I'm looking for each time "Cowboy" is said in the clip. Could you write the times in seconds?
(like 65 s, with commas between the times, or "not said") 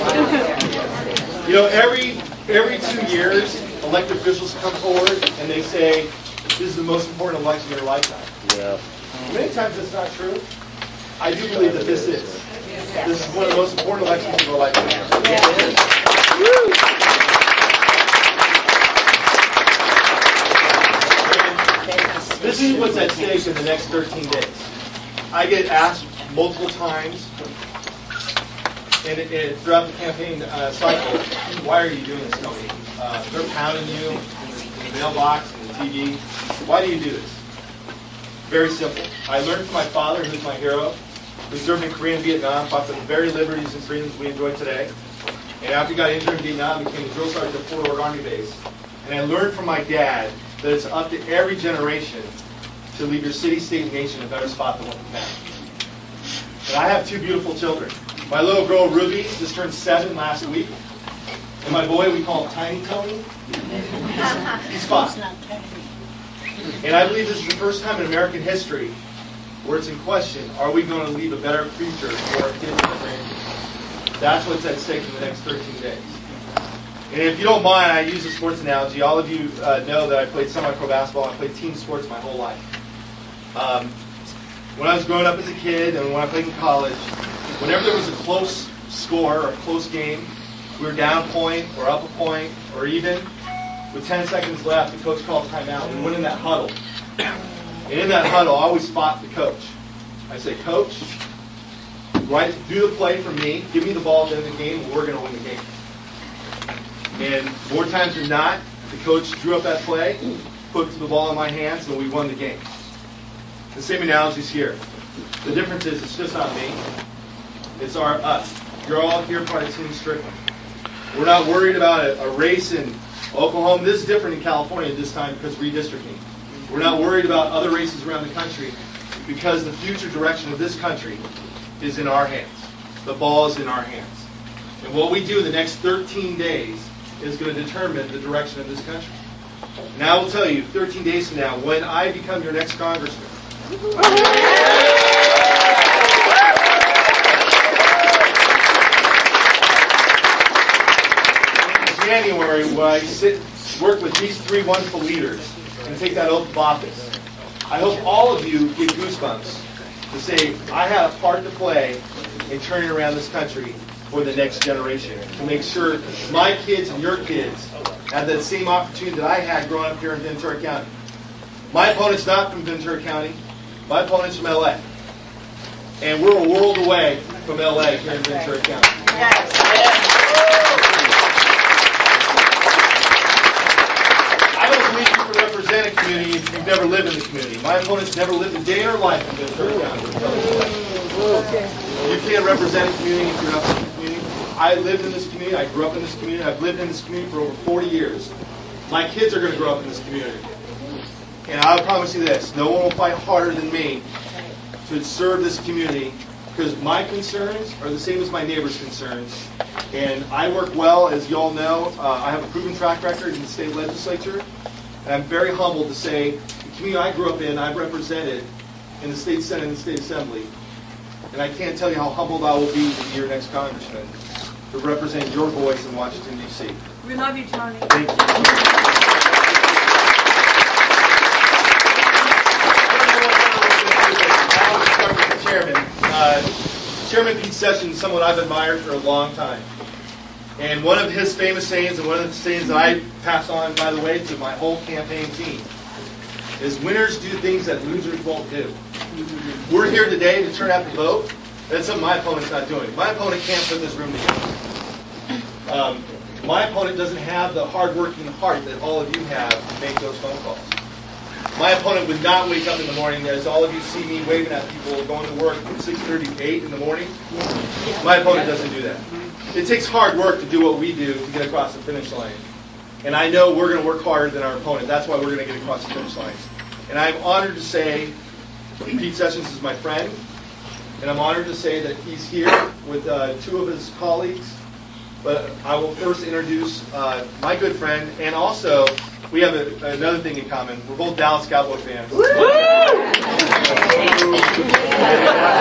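291 s.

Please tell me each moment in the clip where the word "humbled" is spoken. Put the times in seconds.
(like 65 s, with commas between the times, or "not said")
215 s, 222 s.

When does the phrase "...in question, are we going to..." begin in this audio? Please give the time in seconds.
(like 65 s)
69 s.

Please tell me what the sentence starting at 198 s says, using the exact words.
My kids are going to grow up in this community.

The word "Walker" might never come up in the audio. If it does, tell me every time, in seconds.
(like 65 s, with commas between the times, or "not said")
not said.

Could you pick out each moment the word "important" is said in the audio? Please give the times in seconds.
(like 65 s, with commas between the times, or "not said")
7 s, 13 s.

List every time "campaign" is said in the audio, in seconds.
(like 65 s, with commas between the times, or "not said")
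29 s, 244 s.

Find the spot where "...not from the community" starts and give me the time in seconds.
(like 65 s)
193 s.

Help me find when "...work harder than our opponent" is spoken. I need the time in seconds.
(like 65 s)
273 s.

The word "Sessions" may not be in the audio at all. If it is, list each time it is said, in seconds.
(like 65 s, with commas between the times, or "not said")
237 s, 279 s.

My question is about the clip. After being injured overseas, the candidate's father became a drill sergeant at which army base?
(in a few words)
Fort Ord.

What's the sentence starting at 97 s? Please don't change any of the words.
And in that huddle, I always fought the coach.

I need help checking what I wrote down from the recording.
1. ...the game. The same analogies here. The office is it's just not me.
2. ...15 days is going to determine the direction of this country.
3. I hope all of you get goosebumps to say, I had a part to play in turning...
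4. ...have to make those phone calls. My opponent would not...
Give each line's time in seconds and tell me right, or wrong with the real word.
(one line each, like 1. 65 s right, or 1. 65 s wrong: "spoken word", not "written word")
1. 112 s wrong: "difference", not "office"
2. 135 s wrong: "13", not "15"
3. 157 s right
4. 259 s right.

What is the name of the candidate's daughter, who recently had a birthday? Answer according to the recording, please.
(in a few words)
Ruby.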